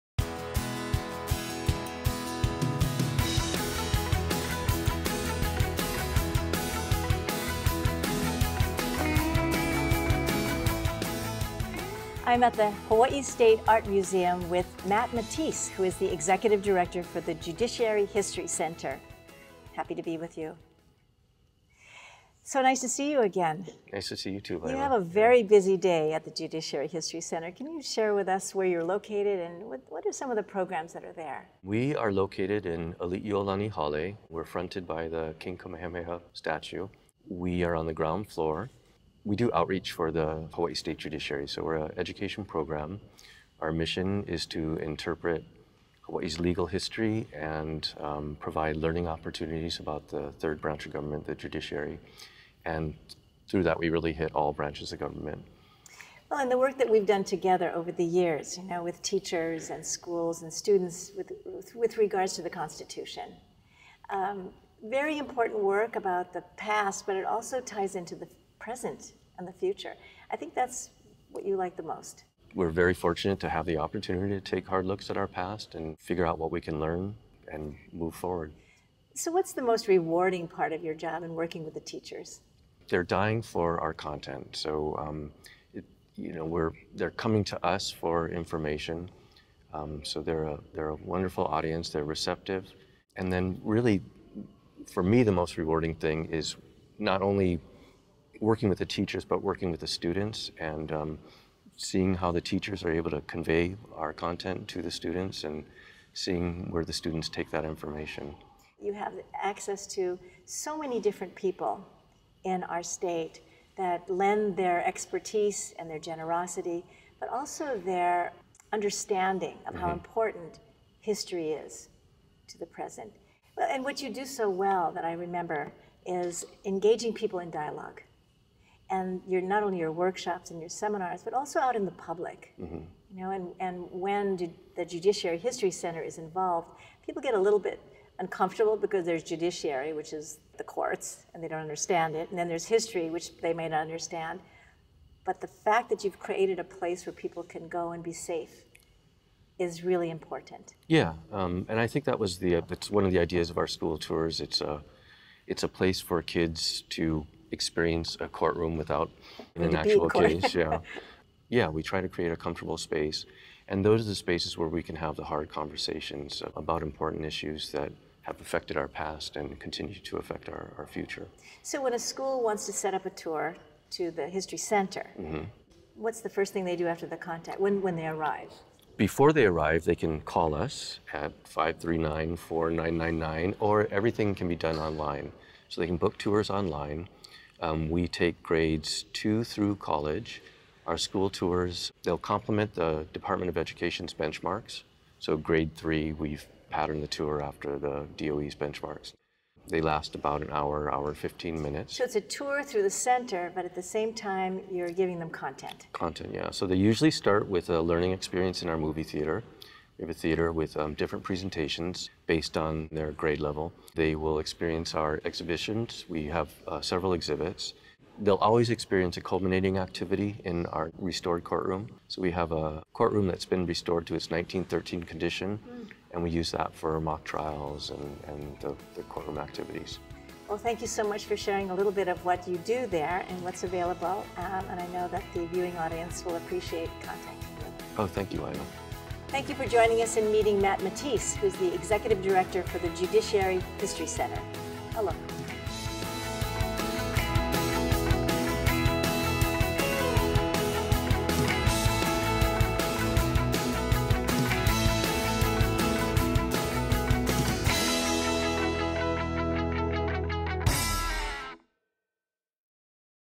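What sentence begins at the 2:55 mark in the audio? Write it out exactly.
what's the first thing they do after the contact, when, when they arrive?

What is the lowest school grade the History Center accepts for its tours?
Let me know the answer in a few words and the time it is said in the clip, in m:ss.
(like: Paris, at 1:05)
grade 2, at 3:09.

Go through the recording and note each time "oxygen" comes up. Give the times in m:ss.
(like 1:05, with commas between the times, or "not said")
not said.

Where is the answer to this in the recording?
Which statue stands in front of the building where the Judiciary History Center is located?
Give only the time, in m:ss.
0:35.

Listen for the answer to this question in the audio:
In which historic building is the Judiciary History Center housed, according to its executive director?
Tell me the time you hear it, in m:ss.
0:33.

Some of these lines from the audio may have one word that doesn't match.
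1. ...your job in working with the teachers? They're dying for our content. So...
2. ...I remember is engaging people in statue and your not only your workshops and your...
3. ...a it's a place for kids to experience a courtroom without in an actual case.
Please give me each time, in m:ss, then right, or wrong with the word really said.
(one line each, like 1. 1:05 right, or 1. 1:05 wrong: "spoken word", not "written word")
1. 1:20 right
2. 2:05 wrong: "dialogue", not "statue"
3. 2:34 right.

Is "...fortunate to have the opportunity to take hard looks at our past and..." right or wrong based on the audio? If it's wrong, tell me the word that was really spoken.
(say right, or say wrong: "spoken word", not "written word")
right.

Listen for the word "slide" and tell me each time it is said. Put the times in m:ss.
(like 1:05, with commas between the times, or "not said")
not said.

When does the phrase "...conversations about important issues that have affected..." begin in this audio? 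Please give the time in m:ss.
2:45.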